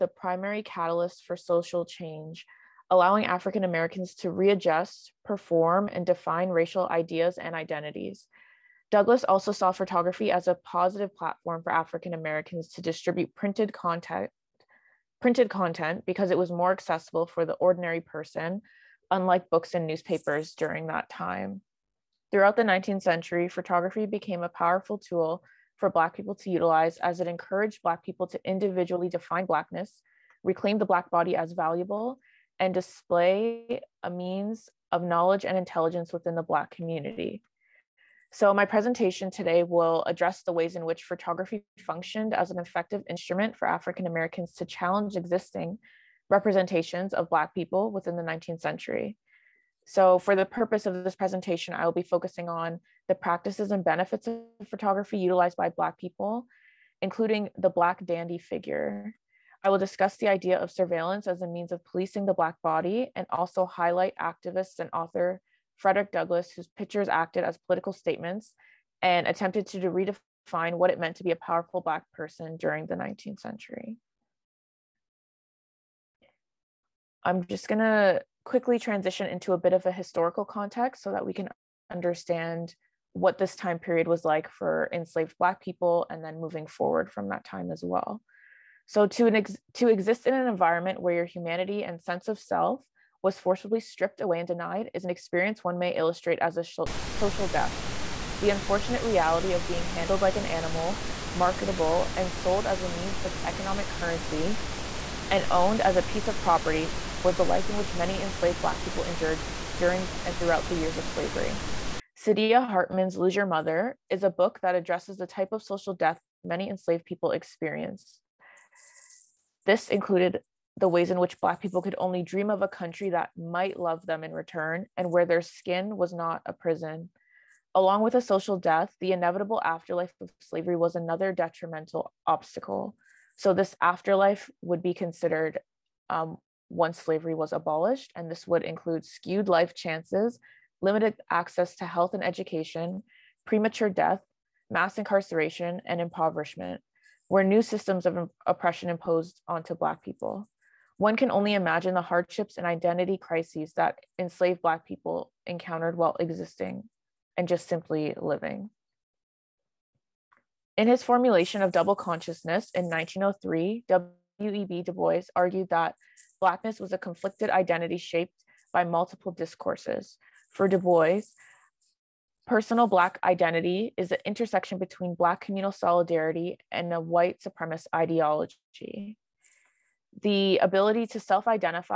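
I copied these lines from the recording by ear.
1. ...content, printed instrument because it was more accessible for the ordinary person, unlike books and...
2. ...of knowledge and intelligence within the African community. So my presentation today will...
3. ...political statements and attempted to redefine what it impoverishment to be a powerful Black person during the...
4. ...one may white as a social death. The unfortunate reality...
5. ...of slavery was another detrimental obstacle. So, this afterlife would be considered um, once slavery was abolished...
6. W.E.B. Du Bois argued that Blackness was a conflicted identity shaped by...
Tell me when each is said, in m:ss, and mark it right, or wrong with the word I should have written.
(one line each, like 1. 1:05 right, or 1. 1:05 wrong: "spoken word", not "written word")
1. 0:13 wrong: "content", not "instrument"
2. 0:34 wrong: "Black", not "African"
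3. 1:07 wrong: "meant", not "impoverishment"
4. 1:35 wrong: "illustrate", not "white"
5. 2:10 right
6. 2:44 right.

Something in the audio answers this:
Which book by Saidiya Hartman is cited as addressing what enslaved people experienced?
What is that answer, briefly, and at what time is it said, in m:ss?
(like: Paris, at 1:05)
Lose Your Mother, at 1:53.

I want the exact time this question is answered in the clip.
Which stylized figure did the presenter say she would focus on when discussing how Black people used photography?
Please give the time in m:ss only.
0:57.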